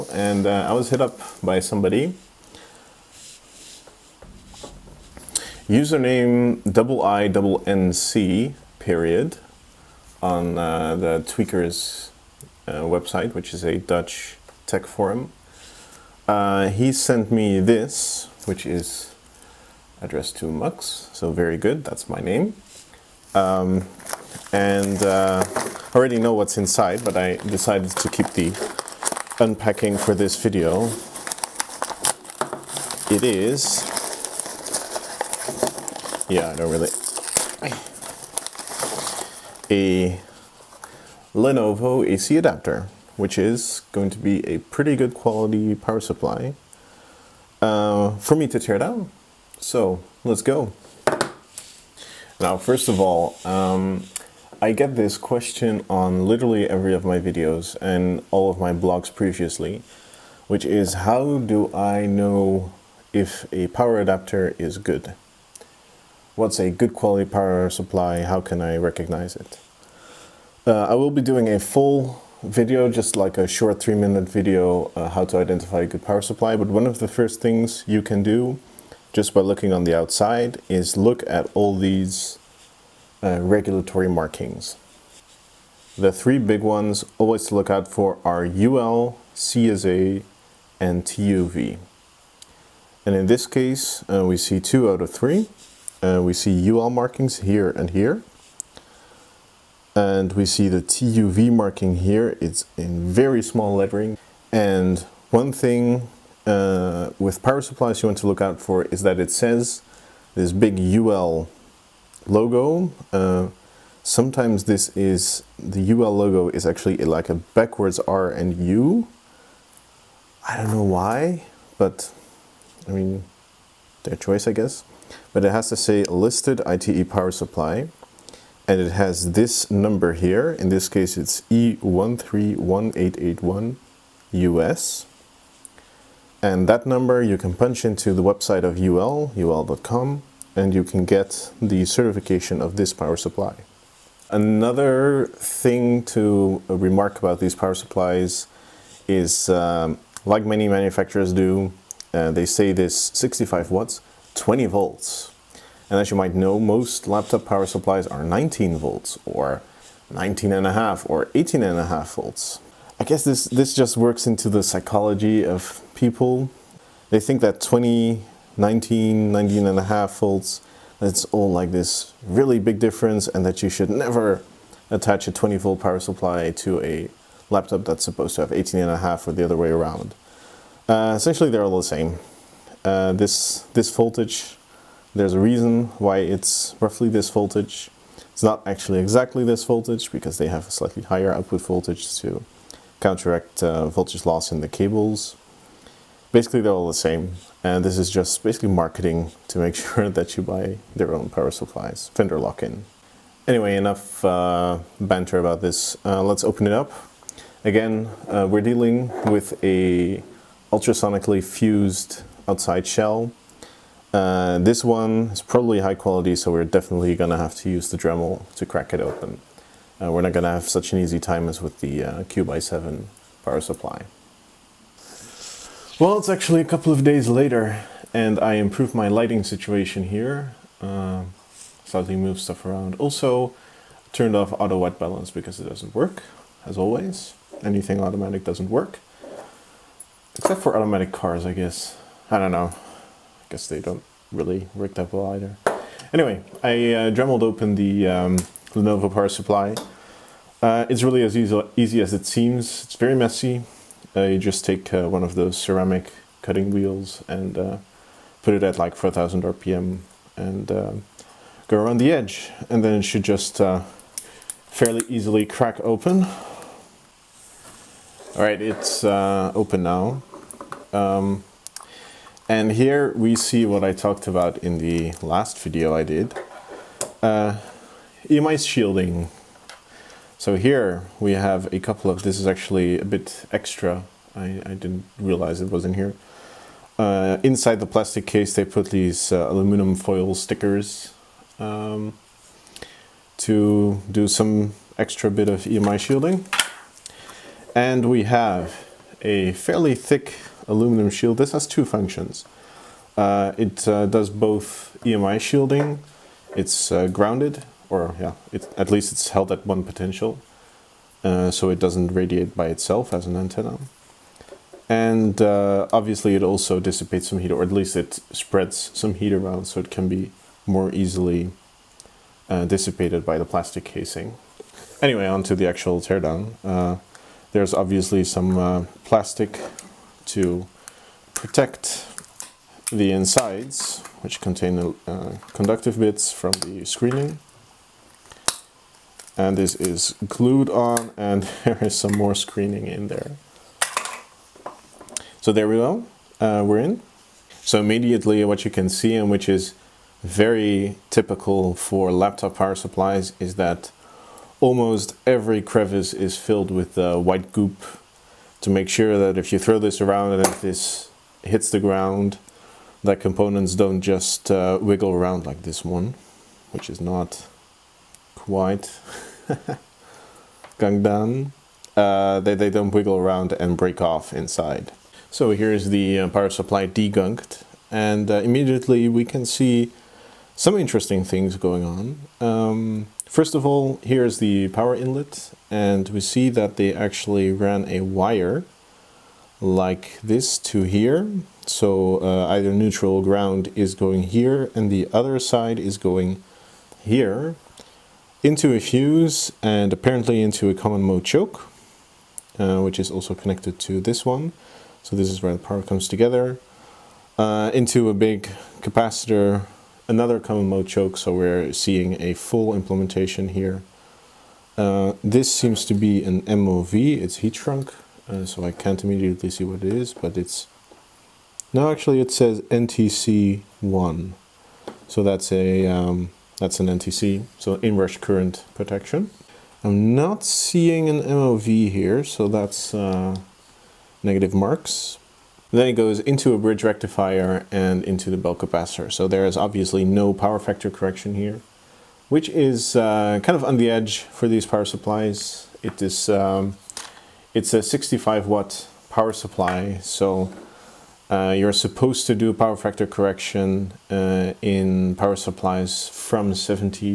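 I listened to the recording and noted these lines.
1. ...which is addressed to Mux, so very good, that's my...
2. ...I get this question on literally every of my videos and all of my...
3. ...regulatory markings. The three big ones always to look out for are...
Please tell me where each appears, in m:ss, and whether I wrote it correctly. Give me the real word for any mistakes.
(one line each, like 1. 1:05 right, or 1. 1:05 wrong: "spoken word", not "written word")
1. 0:18 right
2. 0:54 right
3. 1:23 right.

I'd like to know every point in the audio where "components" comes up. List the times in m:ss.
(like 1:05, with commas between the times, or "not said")
6:03.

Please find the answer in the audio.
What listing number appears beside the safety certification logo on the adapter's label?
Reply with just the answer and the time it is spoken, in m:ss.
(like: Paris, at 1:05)
E131881 US, at 2:11.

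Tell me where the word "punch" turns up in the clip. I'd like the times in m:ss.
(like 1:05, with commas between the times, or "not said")
2:17.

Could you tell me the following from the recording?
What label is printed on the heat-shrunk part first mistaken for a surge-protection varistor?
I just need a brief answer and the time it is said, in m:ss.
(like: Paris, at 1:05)
NTC1, at 7:02.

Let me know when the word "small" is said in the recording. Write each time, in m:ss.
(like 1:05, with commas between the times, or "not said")
1:43.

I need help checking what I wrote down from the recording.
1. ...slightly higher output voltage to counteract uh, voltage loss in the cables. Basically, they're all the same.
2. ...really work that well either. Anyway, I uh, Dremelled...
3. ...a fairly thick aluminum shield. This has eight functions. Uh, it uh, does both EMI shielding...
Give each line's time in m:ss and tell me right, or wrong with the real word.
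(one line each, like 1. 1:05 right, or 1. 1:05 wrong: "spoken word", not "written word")
1. 3:10 right
2. 4:04 right
3. 4:59 wrong: "two", not "eight".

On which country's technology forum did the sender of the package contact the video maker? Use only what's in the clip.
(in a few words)
Dutch.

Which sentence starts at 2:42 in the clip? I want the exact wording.
I guess this, this just works into the psychology of people.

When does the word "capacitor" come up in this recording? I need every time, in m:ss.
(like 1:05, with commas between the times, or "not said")
6:48, 7:18.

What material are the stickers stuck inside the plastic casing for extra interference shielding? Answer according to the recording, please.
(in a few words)
aluminum foil.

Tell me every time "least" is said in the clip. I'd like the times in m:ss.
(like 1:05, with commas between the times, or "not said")
5:08, 5:17.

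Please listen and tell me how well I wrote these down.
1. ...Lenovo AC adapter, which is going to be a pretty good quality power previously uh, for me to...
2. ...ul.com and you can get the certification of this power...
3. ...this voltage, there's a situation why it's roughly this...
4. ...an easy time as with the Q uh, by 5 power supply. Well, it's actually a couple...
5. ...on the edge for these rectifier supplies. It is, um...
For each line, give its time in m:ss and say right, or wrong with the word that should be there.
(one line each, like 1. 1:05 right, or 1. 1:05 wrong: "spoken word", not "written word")
1. 0:41 wrong: "supply", not "previously"
2. 2:19 right
3. 3:03 wrong: "reason", not "situation"
4. 3:40 wrong: "7", not "5"
5. 7:23 wrong: "power", not "rectifier".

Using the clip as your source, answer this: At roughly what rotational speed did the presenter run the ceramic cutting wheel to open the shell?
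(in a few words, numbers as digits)
4000 RPM.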